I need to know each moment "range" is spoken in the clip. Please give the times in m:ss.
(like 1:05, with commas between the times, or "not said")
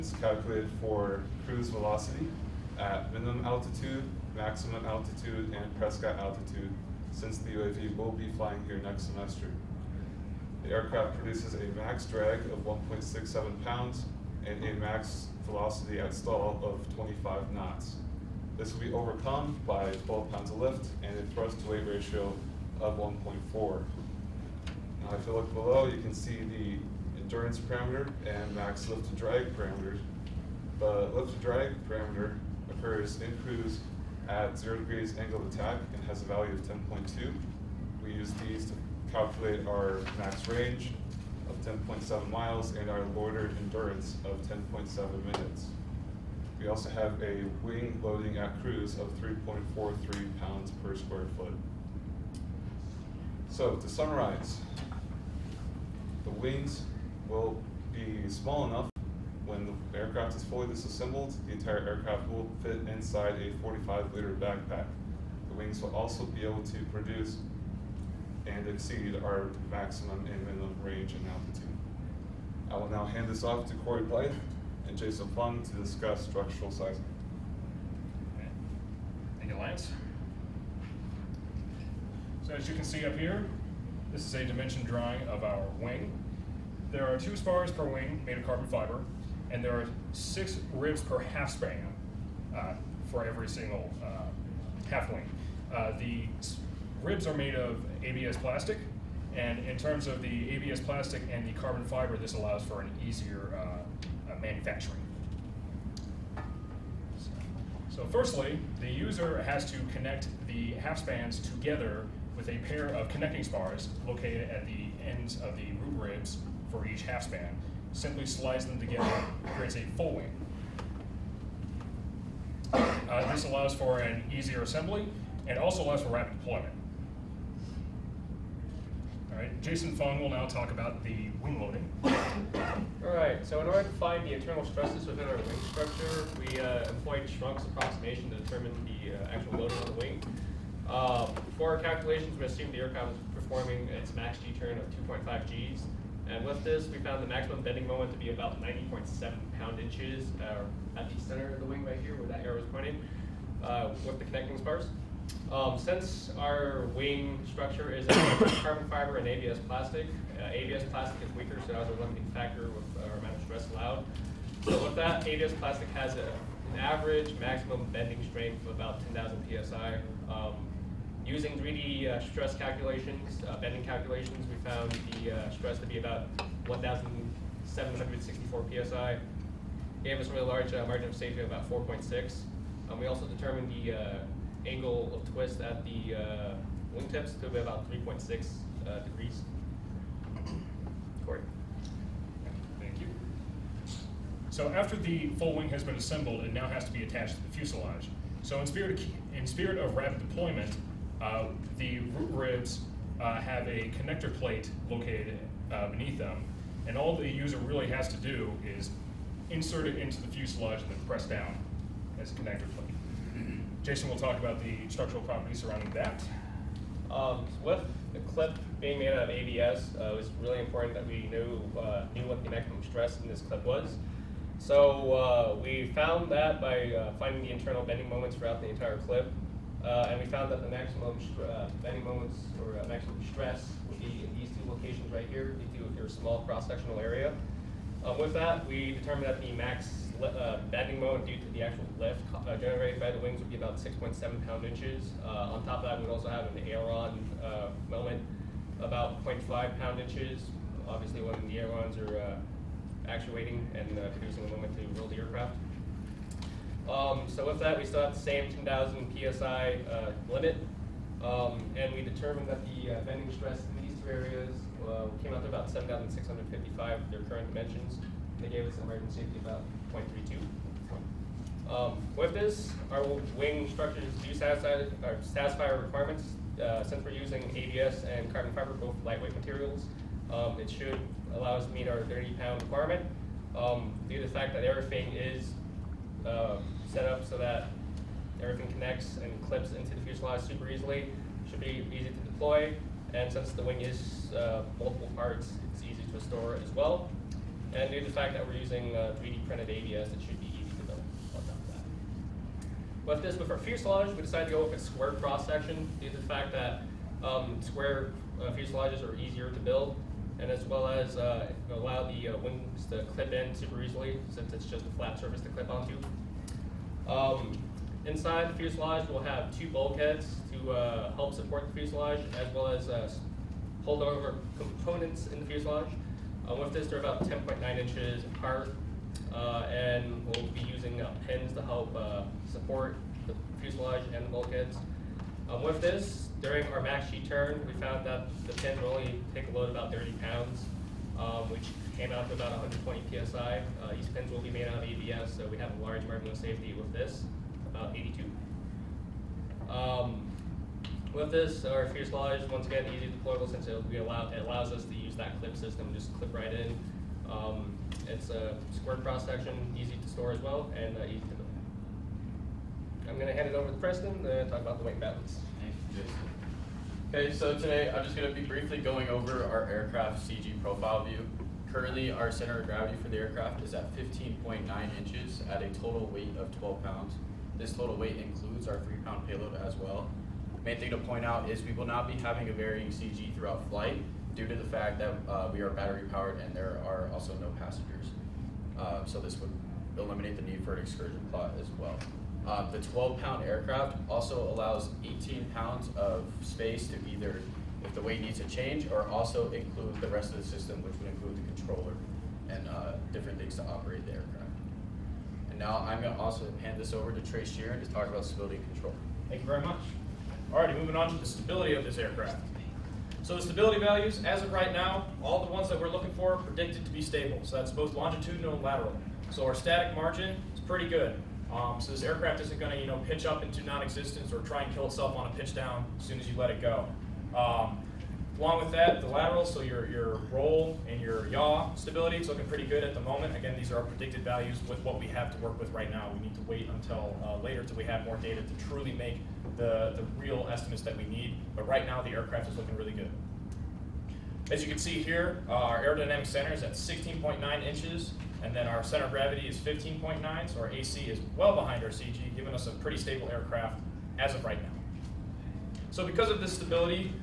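0:40, 1:10.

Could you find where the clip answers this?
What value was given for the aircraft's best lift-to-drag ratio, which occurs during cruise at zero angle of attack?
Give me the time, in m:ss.
0:36.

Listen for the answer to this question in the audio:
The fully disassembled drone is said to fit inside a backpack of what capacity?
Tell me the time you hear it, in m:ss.
1:03.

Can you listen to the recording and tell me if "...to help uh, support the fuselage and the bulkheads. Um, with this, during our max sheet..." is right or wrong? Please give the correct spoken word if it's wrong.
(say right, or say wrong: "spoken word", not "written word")
right.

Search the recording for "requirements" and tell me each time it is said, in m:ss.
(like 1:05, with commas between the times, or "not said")
4:35, 4:42.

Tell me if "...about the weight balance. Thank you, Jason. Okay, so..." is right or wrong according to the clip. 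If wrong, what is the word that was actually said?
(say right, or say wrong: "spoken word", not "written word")
right.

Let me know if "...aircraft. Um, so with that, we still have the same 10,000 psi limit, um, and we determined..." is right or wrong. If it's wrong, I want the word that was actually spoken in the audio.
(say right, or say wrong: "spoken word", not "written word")
right.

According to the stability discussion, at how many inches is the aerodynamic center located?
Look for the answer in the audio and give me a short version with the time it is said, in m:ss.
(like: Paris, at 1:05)
16.9 inches, at 7:26.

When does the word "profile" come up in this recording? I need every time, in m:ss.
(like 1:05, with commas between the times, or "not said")
6:10.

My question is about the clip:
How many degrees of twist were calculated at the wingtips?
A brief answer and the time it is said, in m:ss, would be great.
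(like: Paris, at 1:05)
3.6 degrees, at 3:07.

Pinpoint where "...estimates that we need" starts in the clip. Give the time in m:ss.
7:20.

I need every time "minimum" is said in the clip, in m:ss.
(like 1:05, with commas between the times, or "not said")
0:03, 1:10.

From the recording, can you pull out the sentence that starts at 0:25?
Now if you look below, you can see the endurance parameter and max lift to drag parameters.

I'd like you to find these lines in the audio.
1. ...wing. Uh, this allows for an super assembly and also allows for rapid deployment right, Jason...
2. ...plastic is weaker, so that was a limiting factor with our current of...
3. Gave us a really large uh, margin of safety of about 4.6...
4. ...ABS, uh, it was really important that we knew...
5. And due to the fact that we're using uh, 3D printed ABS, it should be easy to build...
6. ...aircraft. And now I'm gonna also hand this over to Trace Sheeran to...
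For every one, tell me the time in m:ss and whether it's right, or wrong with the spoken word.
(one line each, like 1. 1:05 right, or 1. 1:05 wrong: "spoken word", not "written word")
1. 2:00 wrong: "easier", not "super"
2. 2:40 wrong: "amount", not "current"
3. 3:00 right
4. 3:39 right
5. 4:57 right
6. 6:44 right.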